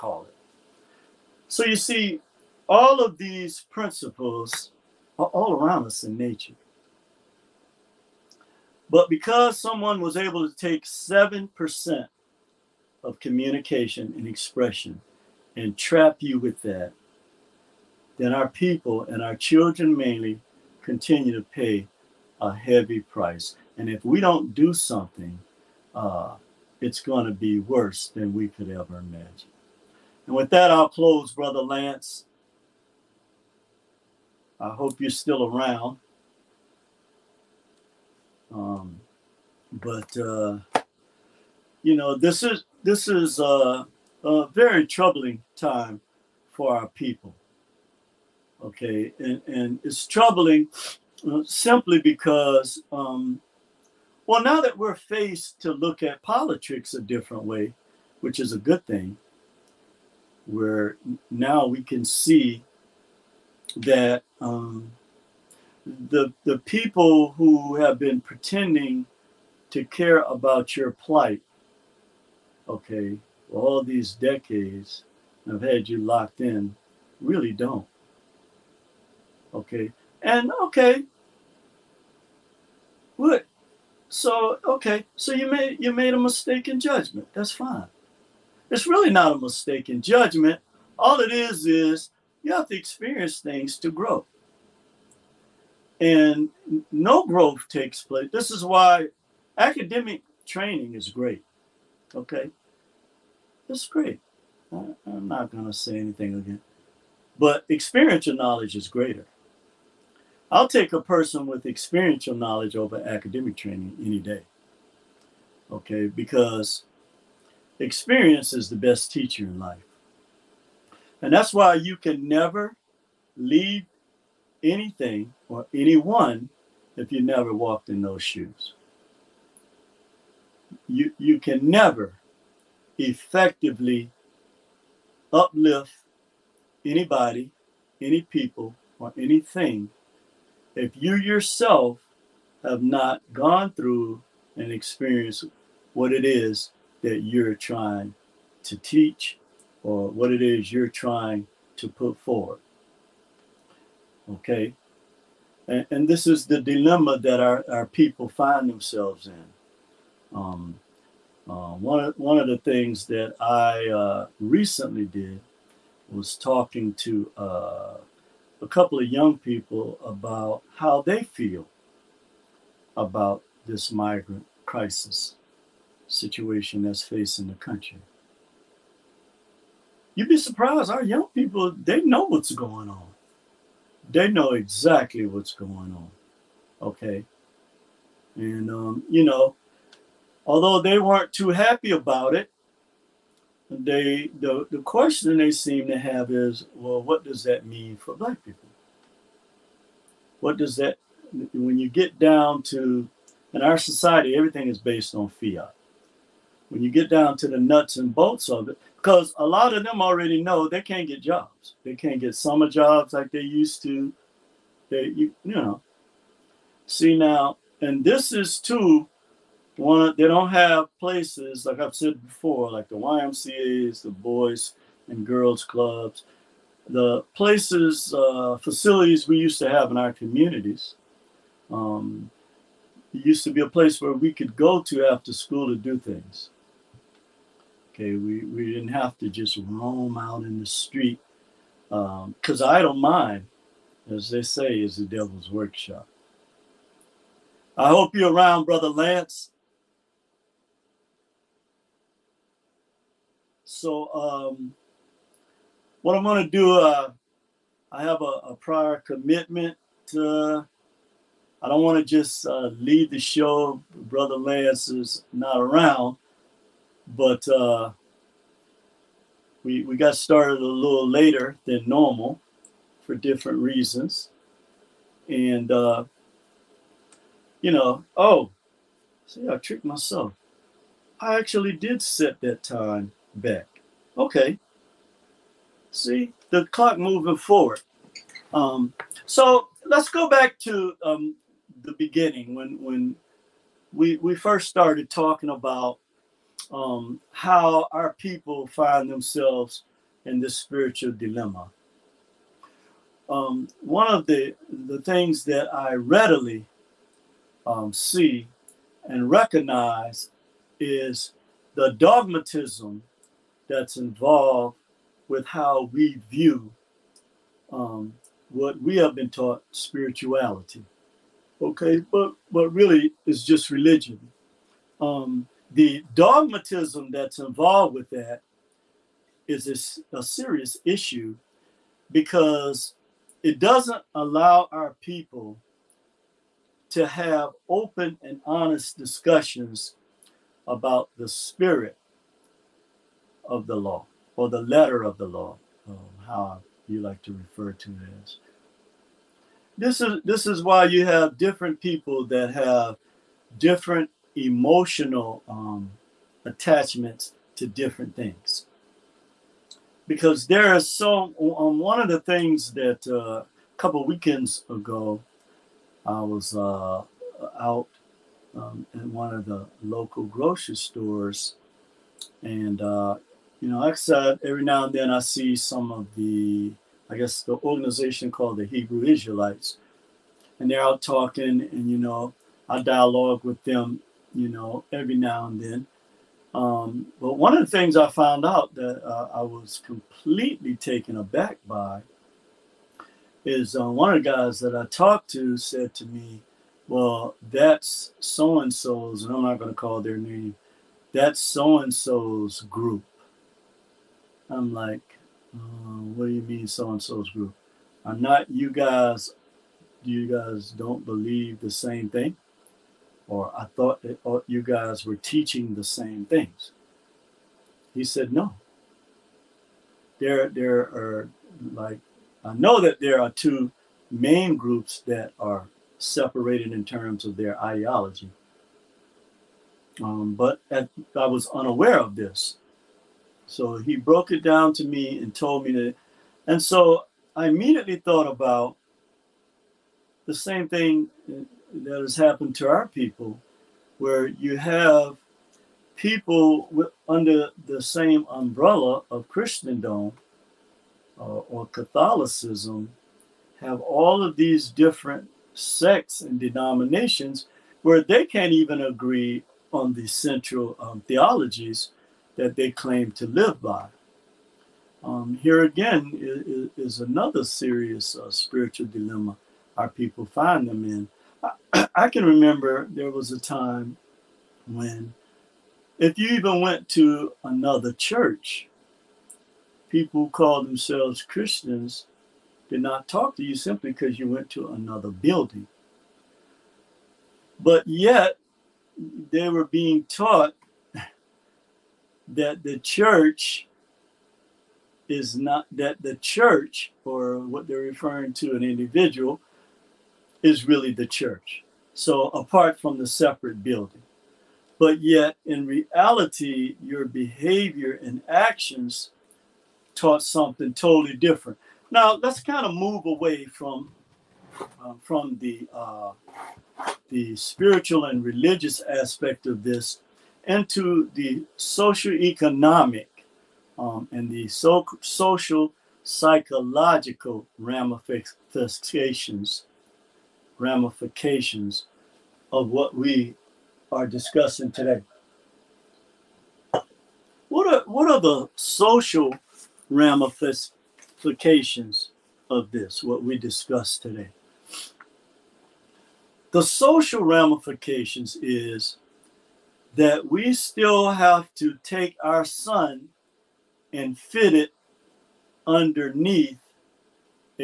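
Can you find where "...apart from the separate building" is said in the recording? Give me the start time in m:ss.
8:22.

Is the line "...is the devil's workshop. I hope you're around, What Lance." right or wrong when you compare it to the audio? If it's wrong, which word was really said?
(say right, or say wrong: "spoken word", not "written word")
wrong: "Brother", not "What".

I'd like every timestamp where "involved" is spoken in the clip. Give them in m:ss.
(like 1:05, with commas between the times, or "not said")
5:13, 5:27.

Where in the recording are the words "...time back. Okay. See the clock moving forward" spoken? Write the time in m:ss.
4:42.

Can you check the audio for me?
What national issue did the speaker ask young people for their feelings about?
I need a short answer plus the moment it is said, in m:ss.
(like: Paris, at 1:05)
Migrant crisis, at 2:53.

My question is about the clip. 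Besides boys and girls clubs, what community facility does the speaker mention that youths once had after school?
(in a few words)
YMCA.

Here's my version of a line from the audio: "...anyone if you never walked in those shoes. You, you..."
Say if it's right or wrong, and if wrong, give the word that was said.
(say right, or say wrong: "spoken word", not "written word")
right.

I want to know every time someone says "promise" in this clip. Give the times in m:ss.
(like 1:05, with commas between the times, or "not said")
not said.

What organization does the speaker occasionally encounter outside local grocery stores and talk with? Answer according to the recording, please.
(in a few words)
Hebrew Israelites.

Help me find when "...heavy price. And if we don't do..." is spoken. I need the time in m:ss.
0:22.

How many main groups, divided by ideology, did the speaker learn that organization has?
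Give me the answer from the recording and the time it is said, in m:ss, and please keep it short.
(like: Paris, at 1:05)
2, at 7:03.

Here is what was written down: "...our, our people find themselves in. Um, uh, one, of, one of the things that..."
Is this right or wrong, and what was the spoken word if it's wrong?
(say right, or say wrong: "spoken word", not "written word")
right.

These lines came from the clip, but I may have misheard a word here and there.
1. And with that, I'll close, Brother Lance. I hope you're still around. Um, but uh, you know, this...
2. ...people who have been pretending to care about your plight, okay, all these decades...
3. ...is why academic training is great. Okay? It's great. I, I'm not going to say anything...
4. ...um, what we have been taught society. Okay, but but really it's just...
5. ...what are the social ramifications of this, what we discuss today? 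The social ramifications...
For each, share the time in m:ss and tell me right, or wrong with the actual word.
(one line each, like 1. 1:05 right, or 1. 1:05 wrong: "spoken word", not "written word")
1. 0:30 right
2. 1:06 right
3. 1:38 right
4. 5:17 wrong: "spirituality", not "society"
5. 8:57 right.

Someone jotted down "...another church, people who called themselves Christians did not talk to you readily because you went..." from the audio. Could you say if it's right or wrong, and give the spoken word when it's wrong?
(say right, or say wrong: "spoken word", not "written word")
wrong: "simply", not "readily".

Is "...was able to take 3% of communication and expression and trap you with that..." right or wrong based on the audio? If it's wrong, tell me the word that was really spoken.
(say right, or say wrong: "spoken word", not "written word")
wrong: "7", not "3".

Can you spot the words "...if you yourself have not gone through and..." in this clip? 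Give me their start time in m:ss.
2:20.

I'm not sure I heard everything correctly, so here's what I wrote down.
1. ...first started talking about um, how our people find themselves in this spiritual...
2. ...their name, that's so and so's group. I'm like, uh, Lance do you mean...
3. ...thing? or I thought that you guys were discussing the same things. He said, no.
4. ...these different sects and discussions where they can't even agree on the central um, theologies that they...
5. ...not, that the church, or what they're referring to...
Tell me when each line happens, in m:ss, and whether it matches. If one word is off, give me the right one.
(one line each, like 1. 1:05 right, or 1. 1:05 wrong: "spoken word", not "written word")
1. 4:54 right
2. 6:40 wrong: "What", not "Lance"
3. 6:52 wrong: "teaching", not "discussing"
4. 7:34 wrong: "denominations", not "discussions"
5. 8:15 right.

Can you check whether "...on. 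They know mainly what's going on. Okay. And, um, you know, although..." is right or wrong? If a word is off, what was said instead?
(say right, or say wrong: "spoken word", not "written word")
wrong: "exactly", not "mainly".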